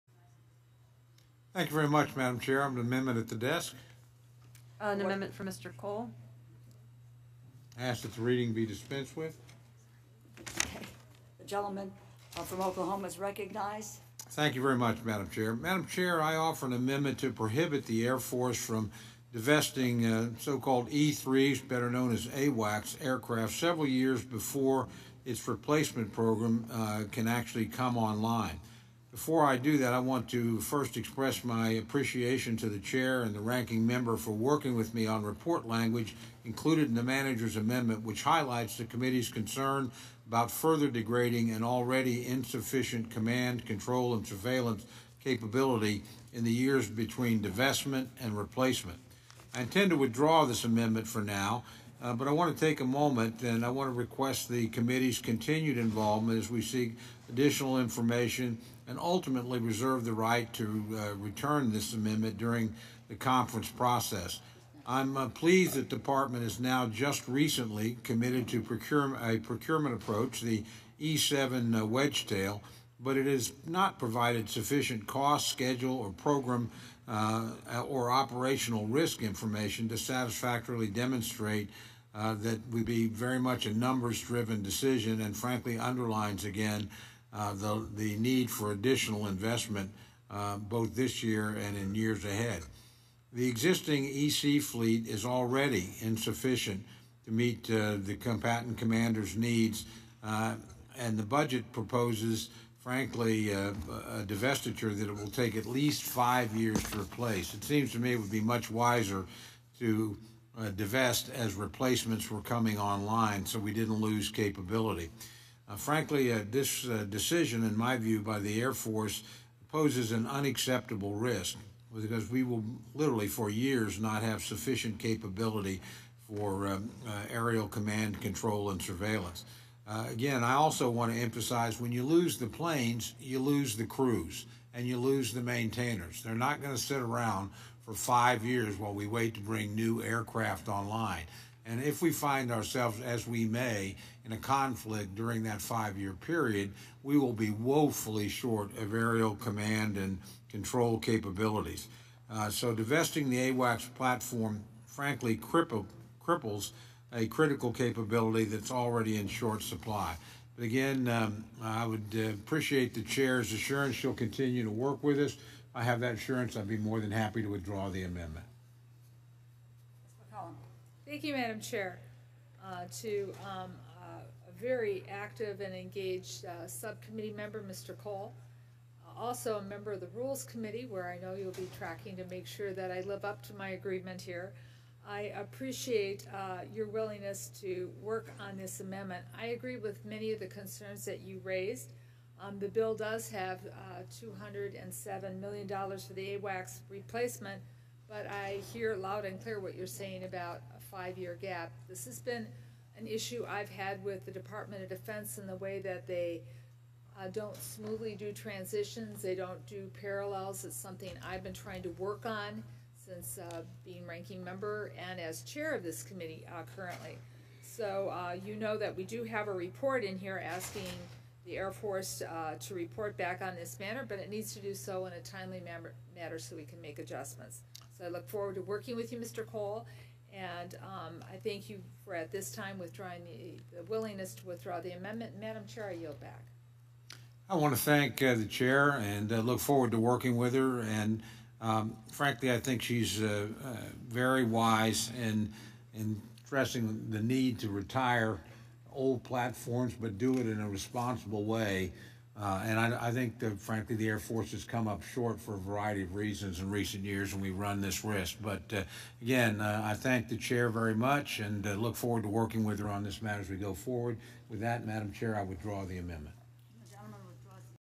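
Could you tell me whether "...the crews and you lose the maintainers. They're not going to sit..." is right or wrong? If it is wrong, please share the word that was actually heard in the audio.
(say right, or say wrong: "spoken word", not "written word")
right.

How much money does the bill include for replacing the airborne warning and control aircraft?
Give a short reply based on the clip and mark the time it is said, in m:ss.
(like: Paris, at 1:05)
$207 million, at 3:14.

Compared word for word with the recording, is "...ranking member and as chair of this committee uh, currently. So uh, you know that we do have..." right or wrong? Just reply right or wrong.
right.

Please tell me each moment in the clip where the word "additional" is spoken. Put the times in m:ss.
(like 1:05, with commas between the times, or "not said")
0:57, 1:28.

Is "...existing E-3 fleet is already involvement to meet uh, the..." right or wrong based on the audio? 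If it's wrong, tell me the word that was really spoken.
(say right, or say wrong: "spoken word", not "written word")
wrong: "insufficient", not "involvement".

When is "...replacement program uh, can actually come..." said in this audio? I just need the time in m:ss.
0:25.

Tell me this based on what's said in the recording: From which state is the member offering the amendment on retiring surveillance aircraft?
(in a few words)
Oklahoma.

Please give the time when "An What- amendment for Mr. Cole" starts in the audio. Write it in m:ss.
0:04.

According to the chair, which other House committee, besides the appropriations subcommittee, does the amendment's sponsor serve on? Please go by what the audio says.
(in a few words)
Rules Committee.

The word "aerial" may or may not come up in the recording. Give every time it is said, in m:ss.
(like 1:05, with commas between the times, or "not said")
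2:07, 2:28.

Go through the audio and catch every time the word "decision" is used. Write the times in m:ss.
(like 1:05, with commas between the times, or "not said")
1:24, 1:57.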